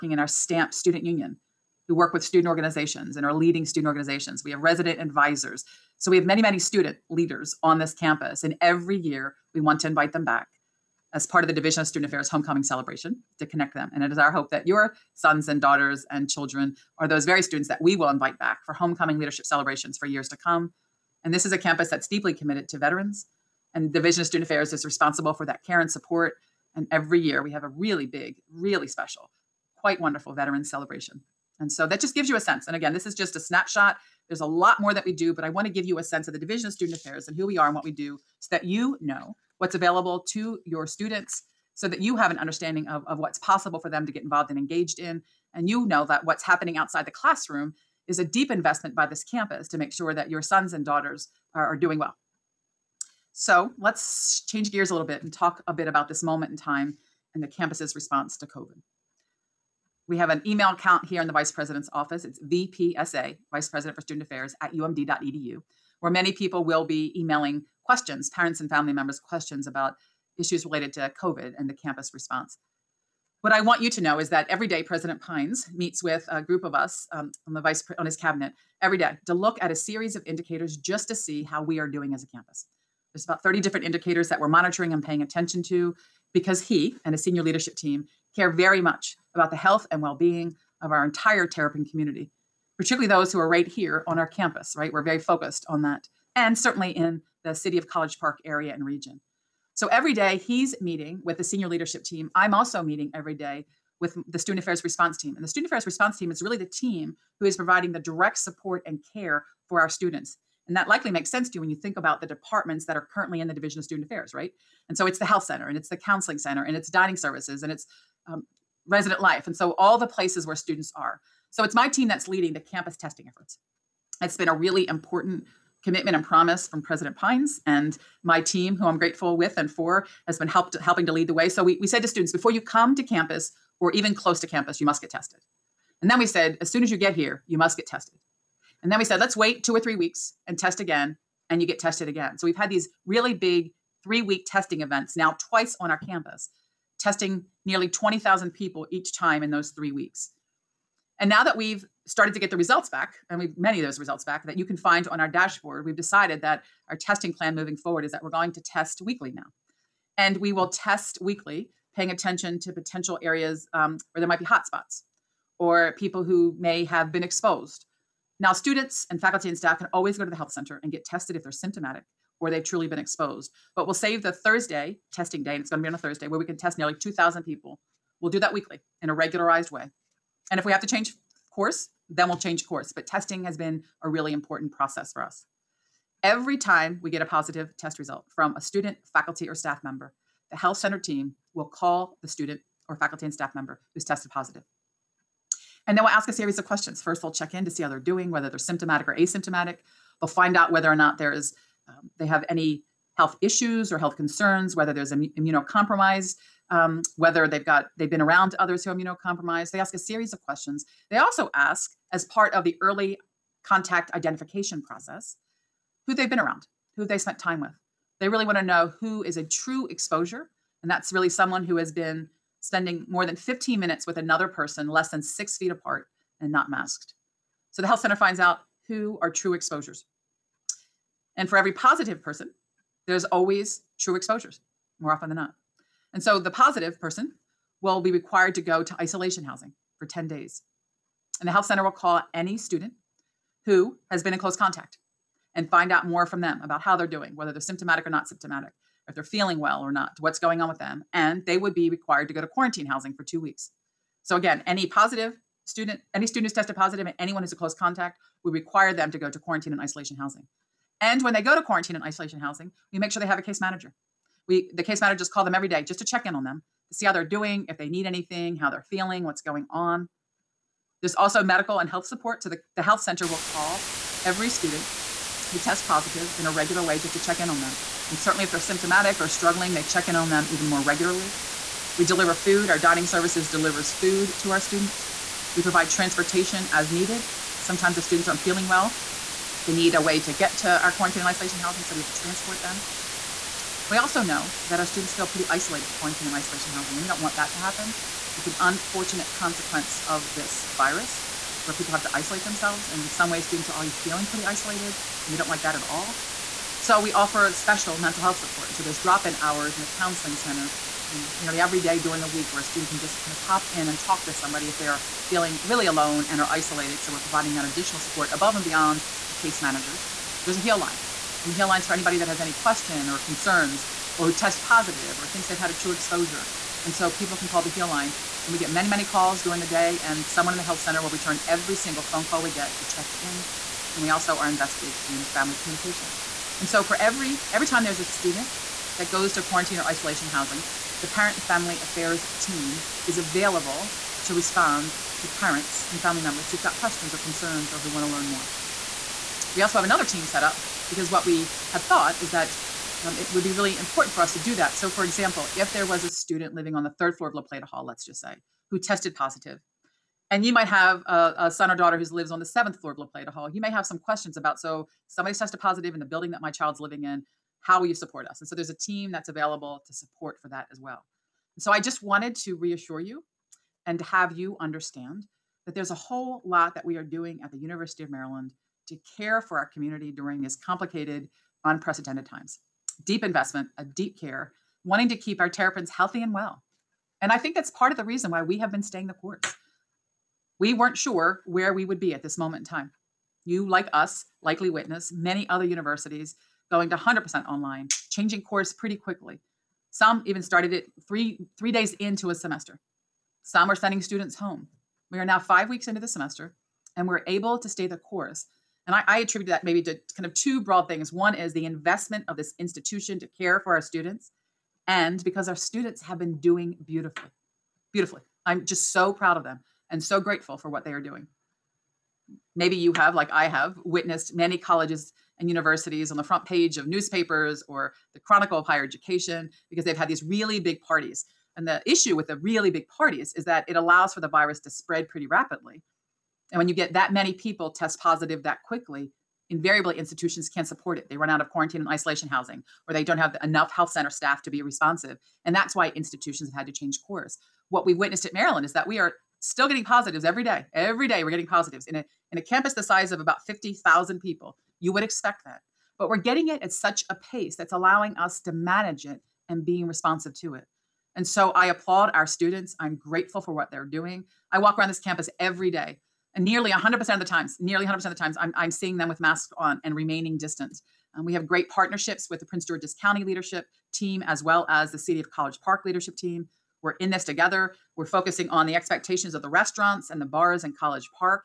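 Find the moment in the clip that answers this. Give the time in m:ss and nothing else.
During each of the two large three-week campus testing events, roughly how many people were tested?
2:27.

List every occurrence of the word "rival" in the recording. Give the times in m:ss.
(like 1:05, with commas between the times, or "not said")
not said.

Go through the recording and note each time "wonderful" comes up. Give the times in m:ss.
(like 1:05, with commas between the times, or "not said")
0:29.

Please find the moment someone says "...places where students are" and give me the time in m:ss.
2:00.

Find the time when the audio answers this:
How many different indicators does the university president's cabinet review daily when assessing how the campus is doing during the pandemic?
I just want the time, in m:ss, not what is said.
1:23.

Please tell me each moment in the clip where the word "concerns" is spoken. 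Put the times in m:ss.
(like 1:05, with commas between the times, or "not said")
3:24, 5:23, 5:47.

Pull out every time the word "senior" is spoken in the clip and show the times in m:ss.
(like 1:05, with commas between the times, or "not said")
1:27, 1:41.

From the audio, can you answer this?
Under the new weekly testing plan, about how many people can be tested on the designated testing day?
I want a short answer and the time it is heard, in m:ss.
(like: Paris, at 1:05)
nearly 2,000, at 2:56.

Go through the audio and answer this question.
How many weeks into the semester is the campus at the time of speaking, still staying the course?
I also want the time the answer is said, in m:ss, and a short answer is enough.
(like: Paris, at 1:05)
5, at 6:45.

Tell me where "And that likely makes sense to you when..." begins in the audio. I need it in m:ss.
1:50.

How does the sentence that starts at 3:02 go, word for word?
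But testing has been a really important process for us.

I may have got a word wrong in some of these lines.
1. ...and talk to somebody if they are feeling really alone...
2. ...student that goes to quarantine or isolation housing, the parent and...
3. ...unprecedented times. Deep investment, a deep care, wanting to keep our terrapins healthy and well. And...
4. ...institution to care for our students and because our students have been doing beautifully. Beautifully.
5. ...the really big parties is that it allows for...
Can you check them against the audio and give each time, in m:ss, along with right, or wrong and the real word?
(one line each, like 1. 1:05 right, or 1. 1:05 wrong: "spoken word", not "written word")
1. 5:13 right
2. 5:38 right
3. 6:21 right
4. 6:52 right
5. 7:12 right.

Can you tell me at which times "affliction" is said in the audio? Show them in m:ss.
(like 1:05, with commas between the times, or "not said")
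not said.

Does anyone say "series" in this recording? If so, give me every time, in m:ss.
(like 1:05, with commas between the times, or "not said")
1:19, 3:16, 3:29.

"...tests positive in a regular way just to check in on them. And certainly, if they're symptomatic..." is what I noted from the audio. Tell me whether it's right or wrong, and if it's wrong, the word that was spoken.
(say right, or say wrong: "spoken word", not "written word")
right.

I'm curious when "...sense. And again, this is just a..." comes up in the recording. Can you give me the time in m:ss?
0:32.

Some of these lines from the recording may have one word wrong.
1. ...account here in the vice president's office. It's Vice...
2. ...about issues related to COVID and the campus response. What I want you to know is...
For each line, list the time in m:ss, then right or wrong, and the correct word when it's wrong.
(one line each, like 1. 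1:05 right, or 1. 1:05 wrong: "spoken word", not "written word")
1. 1:00 wrong: "VPSA", not "Vice"
2. 1:09 right.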